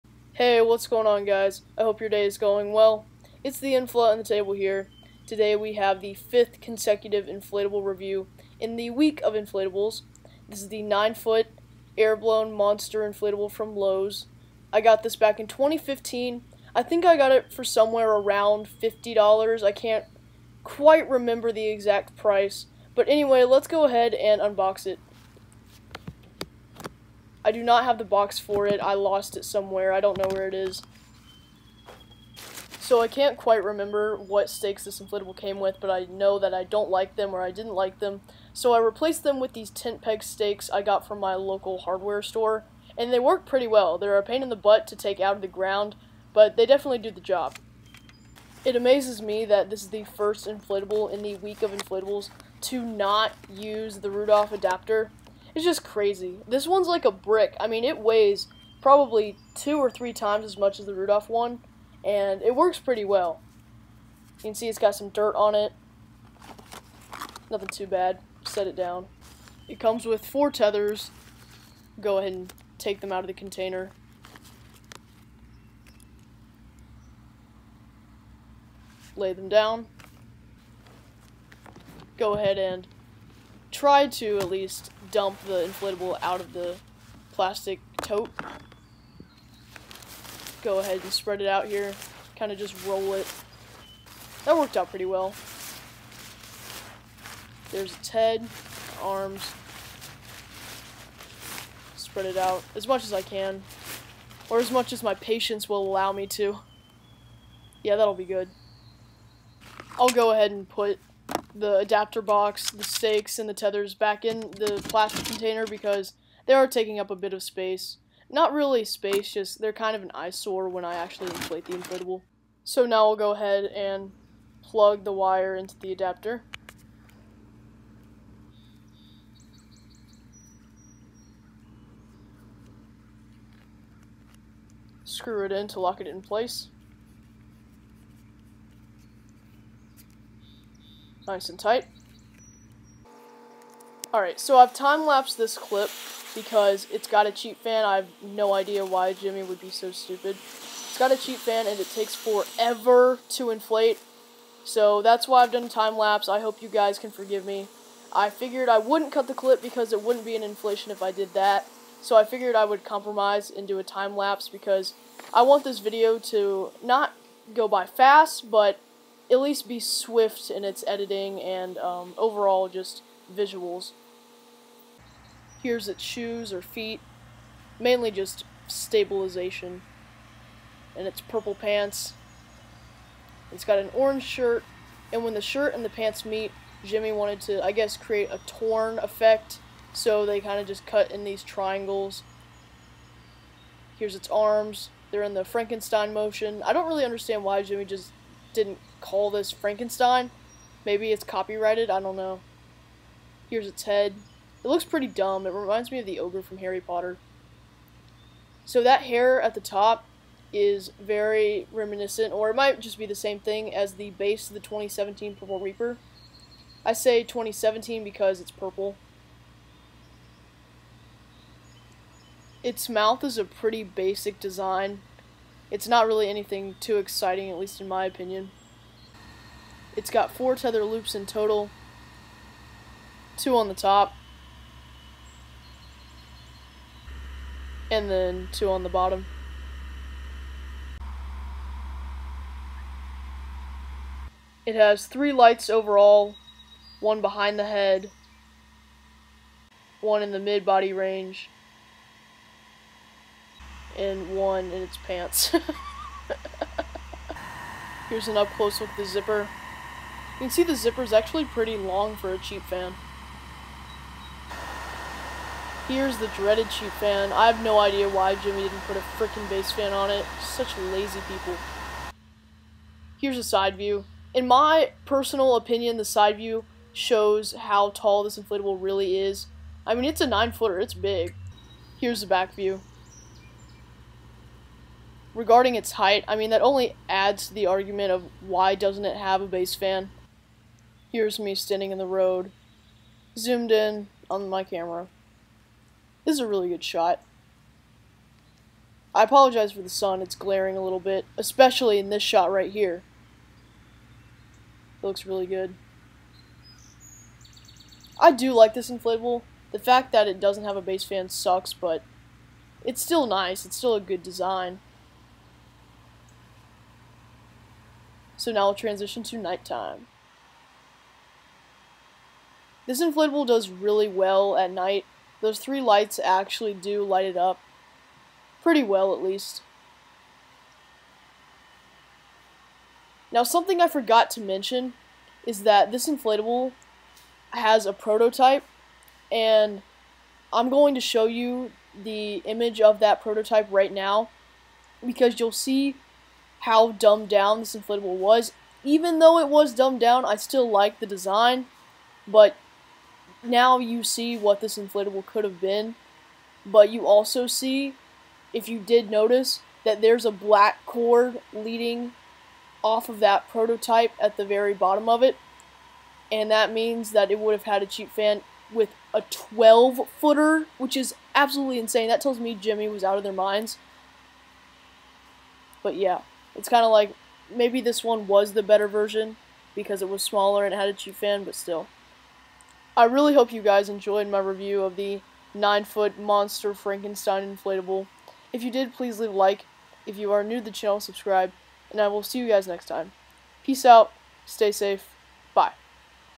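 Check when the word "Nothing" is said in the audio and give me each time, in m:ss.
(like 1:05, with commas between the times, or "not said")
1:07.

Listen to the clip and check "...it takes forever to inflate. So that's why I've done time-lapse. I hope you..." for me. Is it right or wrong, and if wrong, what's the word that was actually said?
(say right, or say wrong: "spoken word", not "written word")
right.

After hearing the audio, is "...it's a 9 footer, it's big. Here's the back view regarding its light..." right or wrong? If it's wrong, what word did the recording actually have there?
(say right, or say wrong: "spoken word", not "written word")
wrong: "height", not "light".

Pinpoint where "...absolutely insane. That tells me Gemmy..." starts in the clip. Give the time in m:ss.
6:11.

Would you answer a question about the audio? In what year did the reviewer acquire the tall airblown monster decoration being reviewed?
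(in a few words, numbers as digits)
2015.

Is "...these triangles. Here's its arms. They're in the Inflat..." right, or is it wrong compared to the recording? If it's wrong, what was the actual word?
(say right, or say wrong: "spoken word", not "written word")
wrong: "Frankenstein", not "Inflat".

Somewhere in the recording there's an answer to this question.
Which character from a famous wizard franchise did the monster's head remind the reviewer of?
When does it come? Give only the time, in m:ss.
3:26.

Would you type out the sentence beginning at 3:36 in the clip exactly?
I say 2017 because it's purple.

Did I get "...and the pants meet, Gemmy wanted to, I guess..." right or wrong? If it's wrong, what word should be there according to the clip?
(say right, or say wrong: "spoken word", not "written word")
right.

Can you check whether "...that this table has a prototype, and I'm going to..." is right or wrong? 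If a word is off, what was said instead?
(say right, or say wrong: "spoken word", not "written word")
wrong: "inflatable", not "table".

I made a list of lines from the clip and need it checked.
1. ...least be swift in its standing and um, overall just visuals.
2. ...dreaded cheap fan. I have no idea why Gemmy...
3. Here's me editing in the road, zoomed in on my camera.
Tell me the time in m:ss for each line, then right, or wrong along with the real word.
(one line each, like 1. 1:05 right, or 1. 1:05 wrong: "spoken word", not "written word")
1. 2:49 wrong: "editing", not "standing"
2. 4:26 right
3. 4:51 wrong: "standing", not "editing".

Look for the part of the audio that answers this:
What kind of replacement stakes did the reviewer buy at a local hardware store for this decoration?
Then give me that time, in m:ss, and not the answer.
0:39.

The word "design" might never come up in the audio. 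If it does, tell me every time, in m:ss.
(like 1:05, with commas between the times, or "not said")
3:44, 5:14, 5:51.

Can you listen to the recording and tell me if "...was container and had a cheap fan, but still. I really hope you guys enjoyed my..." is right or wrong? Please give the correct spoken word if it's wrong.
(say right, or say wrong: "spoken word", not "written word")
wrong: "smaller", not "container".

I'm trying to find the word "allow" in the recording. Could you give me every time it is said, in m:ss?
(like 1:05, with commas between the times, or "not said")
1:45.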